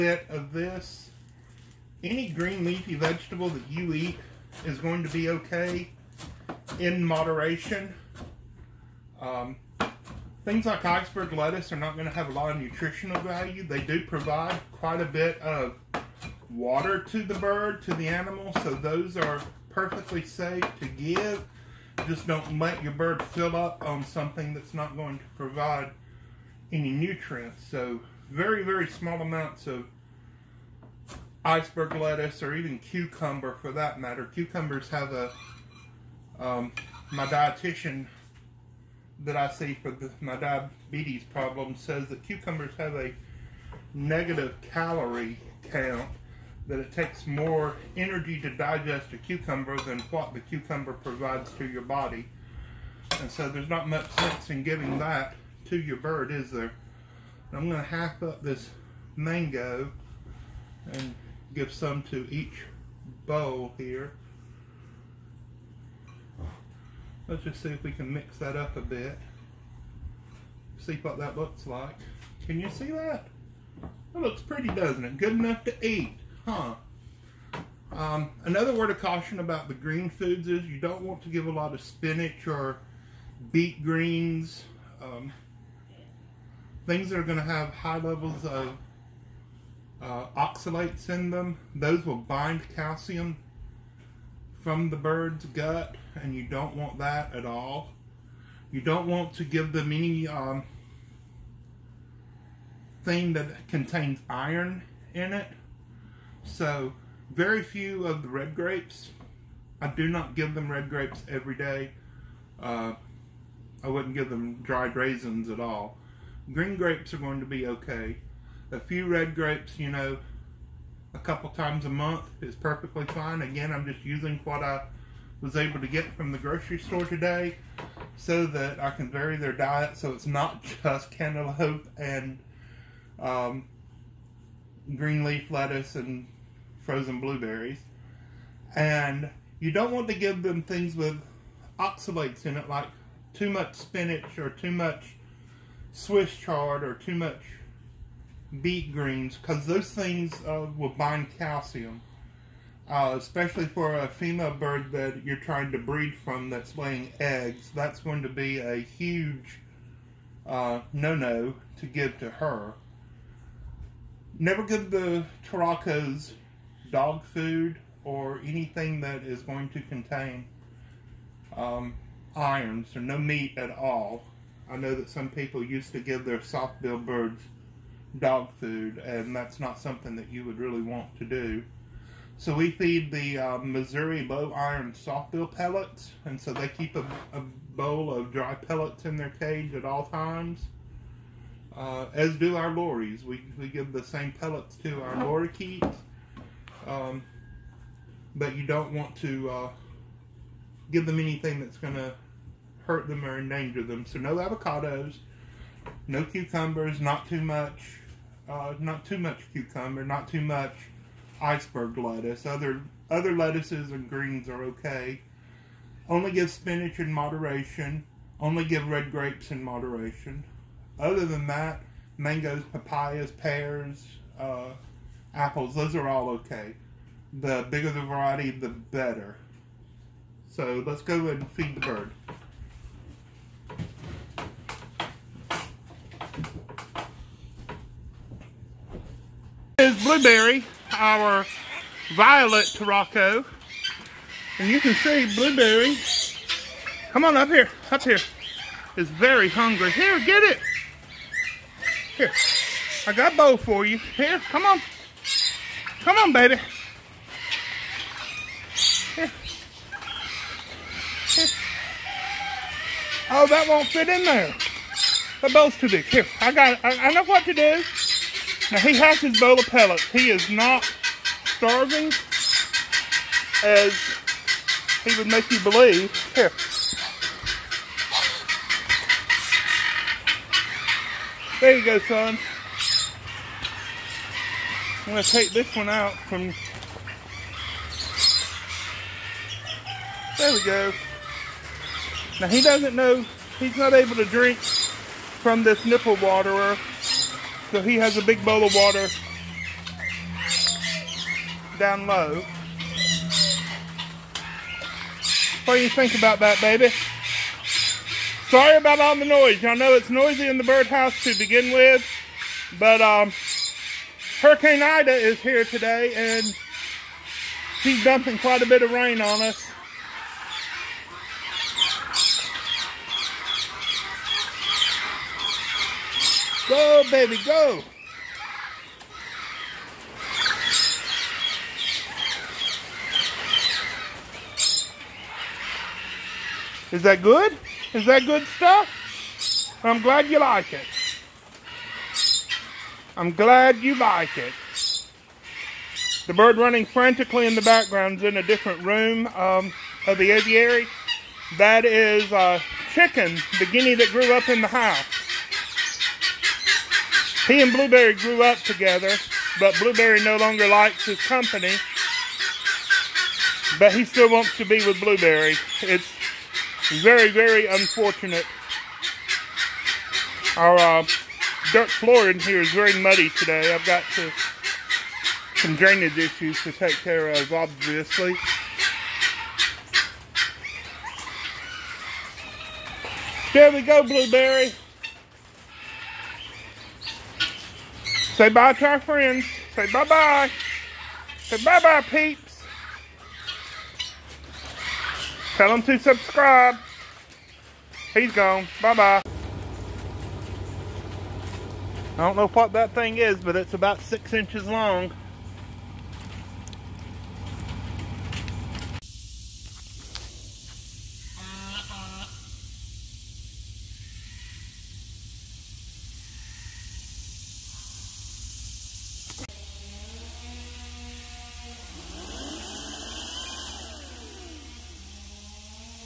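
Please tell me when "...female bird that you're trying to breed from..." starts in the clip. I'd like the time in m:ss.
2:34.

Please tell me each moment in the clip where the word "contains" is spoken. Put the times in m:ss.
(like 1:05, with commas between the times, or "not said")
1:43, 2:49.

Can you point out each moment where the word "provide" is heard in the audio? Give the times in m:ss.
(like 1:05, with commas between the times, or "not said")
0:14, 0:25, 0:50.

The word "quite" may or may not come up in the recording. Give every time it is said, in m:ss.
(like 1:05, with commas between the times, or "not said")
0:14, 5:18.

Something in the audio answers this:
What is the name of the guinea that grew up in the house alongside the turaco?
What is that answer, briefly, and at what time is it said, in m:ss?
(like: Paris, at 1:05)
Chicken, at 5:52.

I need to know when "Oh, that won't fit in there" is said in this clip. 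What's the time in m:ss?
4:23.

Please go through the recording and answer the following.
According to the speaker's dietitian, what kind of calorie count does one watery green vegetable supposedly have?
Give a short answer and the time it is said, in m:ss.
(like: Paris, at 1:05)
negative calorie count, at 0:43.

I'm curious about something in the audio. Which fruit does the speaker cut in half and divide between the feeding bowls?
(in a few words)
mango.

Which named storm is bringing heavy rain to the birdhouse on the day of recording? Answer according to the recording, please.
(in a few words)
Hurricane Ida.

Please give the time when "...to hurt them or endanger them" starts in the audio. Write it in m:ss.
3:21.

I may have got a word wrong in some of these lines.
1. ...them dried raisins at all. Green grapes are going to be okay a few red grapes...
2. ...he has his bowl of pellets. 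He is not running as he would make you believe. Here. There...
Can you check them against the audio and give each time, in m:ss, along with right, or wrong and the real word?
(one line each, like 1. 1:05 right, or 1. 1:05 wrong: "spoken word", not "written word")
1. 1:54 right
2. 4:28 wrong: "starving", not "running".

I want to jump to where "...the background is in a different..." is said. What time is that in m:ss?
5:47.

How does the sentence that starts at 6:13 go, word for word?
I've got to, some drainage issues to take care of, obviously.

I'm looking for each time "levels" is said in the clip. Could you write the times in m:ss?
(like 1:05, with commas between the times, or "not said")
1:27.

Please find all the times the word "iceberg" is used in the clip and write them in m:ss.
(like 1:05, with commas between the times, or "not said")
0:10, 0:31, 3:31.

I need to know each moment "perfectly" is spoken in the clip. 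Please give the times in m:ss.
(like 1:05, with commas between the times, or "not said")
0:19, 2:02.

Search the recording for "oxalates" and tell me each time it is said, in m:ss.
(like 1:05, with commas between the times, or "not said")
1:30, 2:21.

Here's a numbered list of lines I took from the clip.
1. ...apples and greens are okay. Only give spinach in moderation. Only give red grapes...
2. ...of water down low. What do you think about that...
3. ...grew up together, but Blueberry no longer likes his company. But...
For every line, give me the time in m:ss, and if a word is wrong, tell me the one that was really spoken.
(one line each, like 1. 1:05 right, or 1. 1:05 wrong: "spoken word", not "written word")
1. 3:33 wrong: "lettuces", not "apples"
2. 4:58 right
3. 5:58 right.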